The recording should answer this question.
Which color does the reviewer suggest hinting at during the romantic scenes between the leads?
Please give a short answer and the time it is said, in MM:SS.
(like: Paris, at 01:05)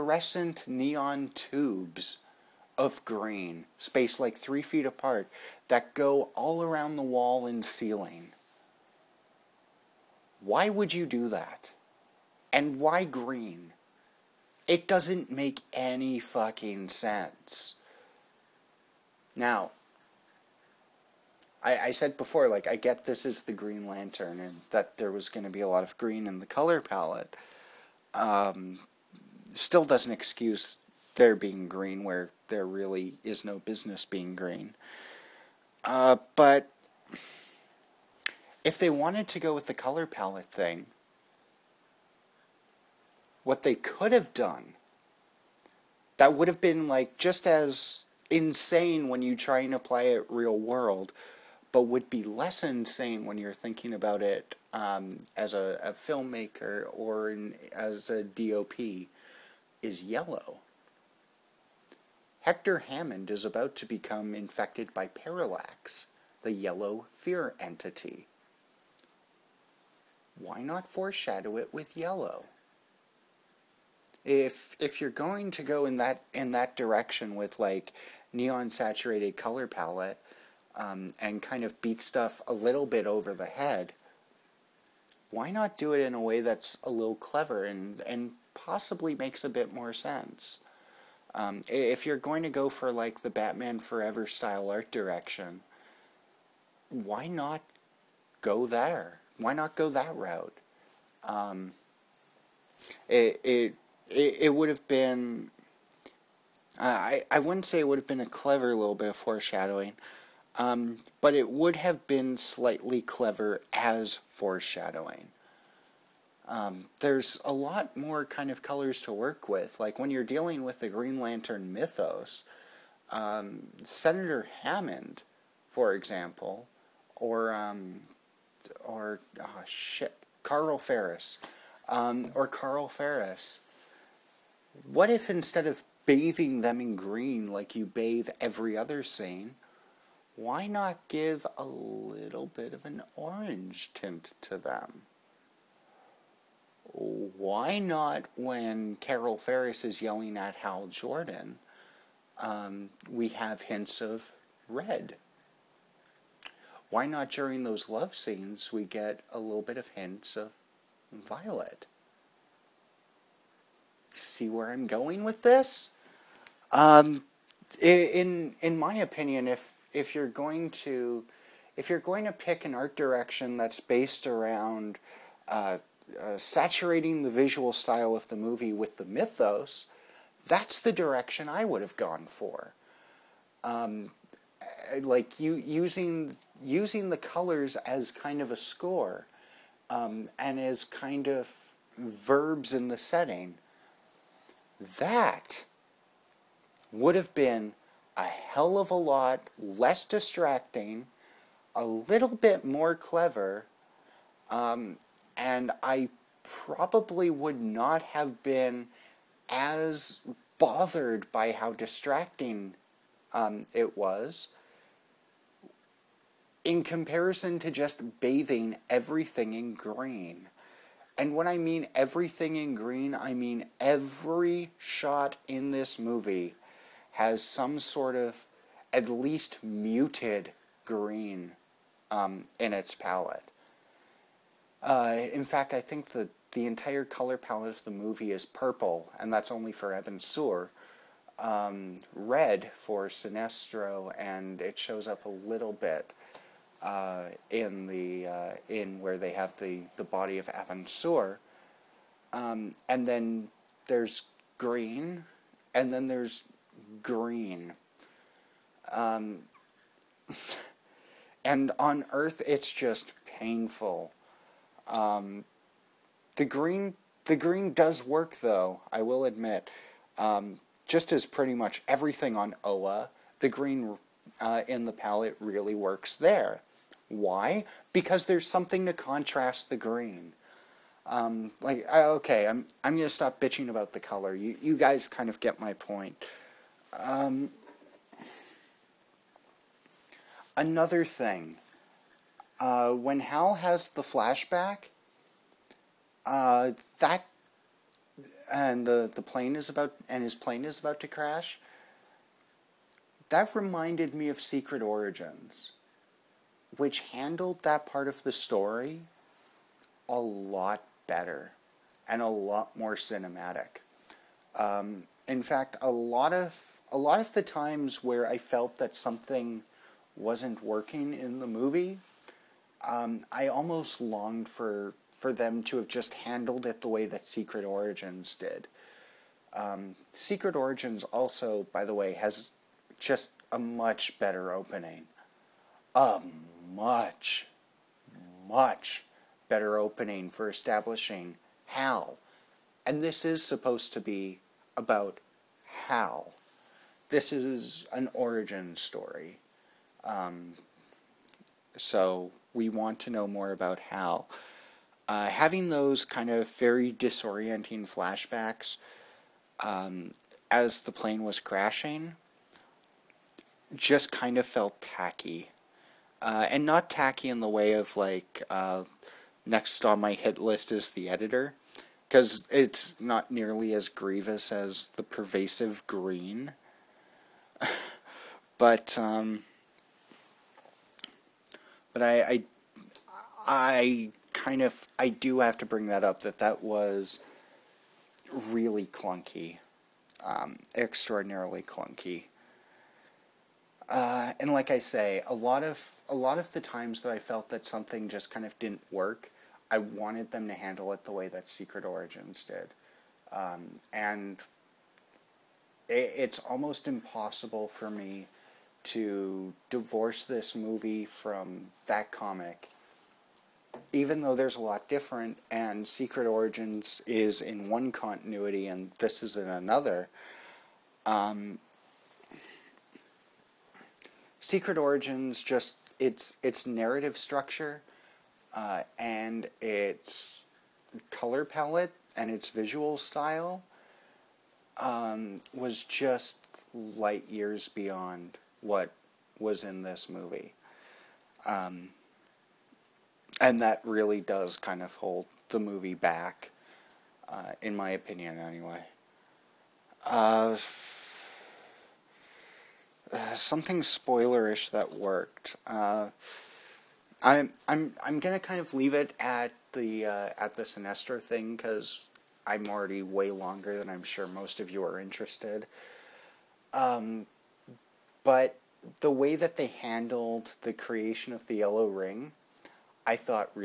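Violet, at 02:41.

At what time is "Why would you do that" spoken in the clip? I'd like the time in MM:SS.
00:10.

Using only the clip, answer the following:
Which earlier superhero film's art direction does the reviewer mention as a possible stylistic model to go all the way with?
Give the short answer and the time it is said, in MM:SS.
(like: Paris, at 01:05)
Batman Forever, at 01:33.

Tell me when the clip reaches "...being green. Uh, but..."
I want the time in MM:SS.
00:34.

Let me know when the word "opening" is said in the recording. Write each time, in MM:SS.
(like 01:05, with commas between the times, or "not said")
05:34, 05:39.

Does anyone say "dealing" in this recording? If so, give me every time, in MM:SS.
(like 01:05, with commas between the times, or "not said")
02:00.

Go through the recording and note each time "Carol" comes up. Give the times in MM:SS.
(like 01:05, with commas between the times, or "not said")
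02:29.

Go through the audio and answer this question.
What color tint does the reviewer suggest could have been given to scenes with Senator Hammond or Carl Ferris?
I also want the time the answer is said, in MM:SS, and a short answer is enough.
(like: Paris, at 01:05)
Orange, at 02:23.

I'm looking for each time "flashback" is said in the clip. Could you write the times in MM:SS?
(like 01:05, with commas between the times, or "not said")
04:54, 05:57.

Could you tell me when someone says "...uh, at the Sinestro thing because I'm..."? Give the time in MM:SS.
07:40.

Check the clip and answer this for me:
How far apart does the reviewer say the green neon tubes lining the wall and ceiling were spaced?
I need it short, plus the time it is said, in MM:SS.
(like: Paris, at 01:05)
3 feet, at 00:04.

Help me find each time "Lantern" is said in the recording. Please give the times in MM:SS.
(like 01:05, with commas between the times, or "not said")
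00:23, 02:01.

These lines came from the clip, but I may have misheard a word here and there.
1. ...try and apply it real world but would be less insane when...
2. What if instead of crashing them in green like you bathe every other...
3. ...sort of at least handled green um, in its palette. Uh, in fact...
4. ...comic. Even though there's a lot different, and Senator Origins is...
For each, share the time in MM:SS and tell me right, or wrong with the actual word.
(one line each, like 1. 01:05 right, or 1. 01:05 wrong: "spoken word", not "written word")
1. 00:49 right
2. 02:14 wrong: "bathing", not "crashing"
3. 03:47 wrong: "muted", not "handled"
4. 06:52 wrong: "Secret", not "Senator".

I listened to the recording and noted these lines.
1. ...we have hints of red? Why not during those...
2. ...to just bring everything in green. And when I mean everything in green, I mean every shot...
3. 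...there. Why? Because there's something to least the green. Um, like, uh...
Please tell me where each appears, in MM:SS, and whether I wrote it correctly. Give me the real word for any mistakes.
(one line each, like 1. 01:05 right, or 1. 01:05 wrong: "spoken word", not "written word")
1. 02:33 right
2. 03:37 wrong: "bathing", not "bring"
3. 04:36 wrong: "contrast", not "least".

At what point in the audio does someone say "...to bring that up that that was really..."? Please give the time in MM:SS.
06:25.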